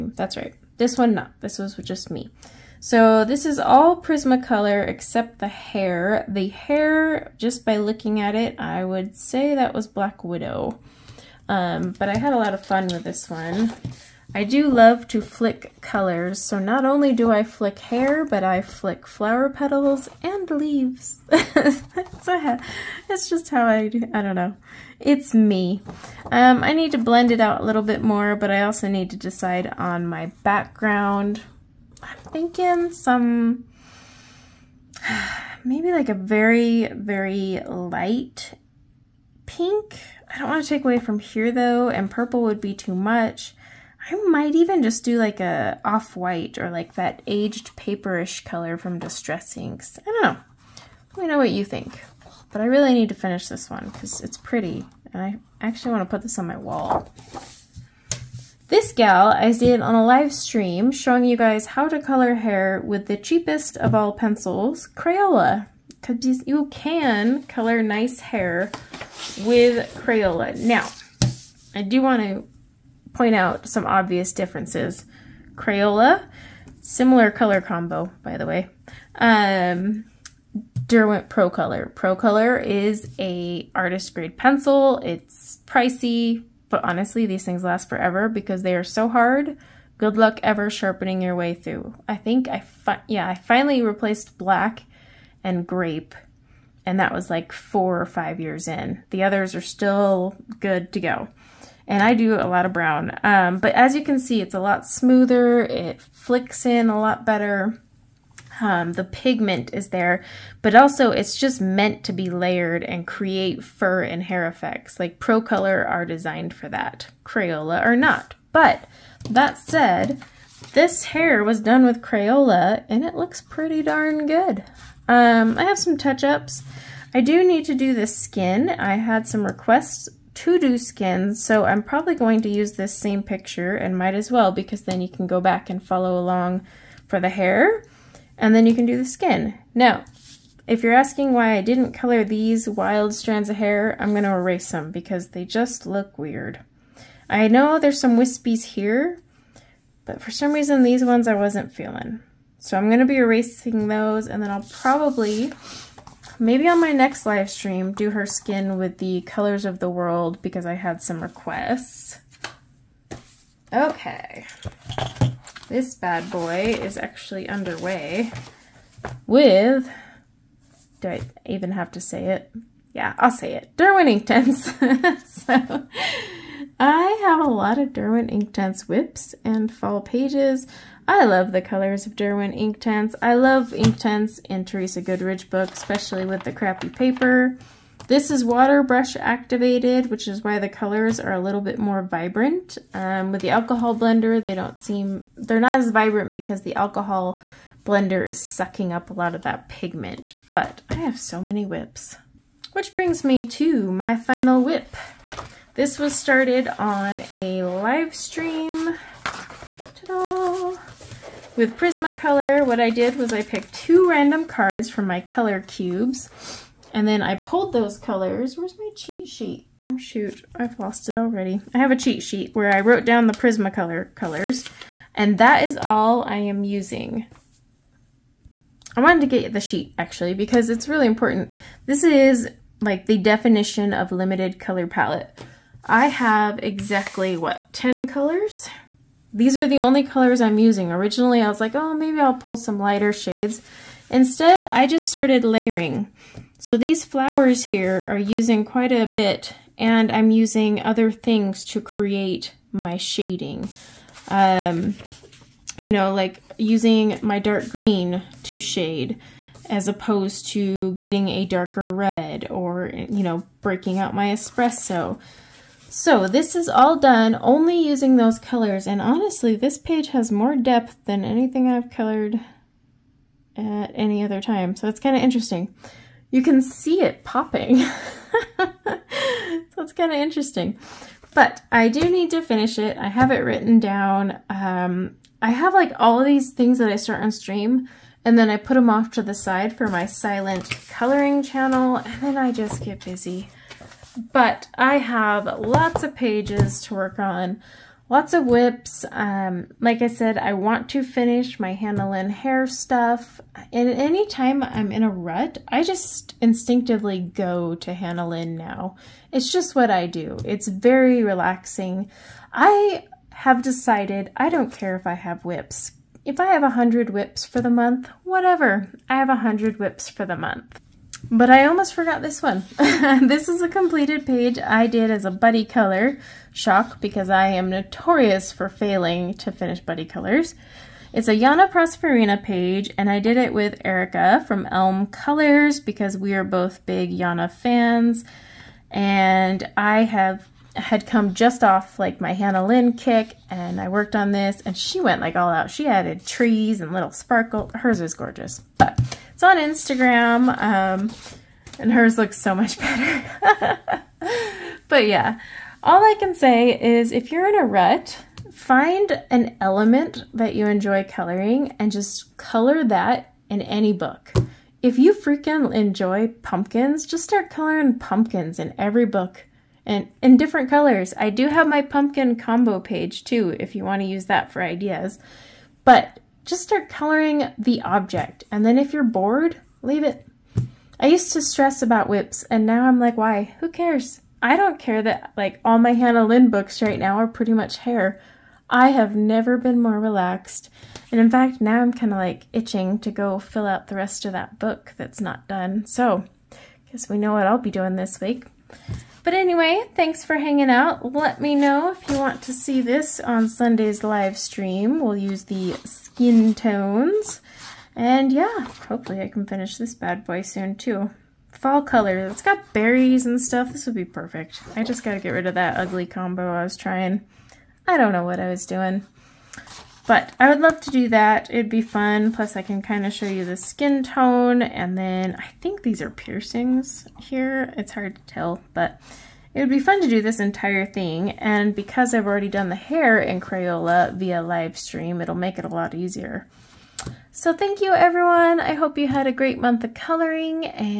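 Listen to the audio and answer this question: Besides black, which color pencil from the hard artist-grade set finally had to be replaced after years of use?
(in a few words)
grape.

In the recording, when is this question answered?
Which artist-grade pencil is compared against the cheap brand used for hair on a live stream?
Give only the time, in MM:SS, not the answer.
01:20.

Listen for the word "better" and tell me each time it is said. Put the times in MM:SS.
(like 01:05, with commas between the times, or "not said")
01:47, 05:52.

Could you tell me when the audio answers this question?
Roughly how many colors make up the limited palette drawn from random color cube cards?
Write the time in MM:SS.
03:57.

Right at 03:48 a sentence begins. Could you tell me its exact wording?
I wanted to get the sheet, actually, because it's really important.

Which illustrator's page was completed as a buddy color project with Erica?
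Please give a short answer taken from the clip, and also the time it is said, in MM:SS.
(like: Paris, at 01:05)
Yana Prosperina, at 05:31.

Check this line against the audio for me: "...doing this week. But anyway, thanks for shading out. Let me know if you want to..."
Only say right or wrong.
wrong.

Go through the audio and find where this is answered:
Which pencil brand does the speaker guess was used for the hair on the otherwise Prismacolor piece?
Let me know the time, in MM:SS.
00:09.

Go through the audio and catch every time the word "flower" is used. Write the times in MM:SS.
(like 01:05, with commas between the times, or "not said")
00:19, 04:07.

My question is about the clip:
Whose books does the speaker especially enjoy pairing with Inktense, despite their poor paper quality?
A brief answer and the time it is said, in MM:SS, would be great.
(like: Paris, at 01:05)
Teresa Goodridge, at 03:04.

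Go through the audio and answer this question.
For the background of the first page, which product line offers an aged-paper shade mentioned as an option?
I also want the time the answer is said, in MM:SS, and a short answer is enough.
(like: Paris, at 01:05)
Distress Inks, at 00:48.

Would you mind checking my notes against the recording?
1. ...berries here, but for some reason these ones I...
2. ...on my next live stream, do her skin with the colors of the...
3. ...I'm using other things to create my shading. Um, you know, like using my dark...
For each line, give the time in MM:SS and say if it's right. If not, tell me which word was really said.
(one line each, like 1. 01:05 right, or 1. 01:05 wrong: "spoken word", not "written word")
1. 02:28 wrong: "wispies", not "berries"
2. 02:36 right
3. 04:10 right.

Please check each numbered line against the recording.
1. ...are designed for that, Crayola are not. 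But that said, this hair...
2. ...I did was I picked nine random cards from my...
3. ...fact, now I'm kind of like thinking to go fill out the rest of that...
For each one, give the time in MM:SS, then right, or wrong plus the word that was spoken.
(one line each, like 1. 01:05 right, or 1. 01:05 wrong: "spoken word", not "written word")
1. 01:55 right
2. 03:32 wrong: "two", not "nine"
3. 06:31 wrong: "itching", not "thinking".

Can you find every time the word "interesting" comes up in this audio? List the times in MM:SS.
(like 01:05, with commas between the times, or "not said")
04:35, 04:40.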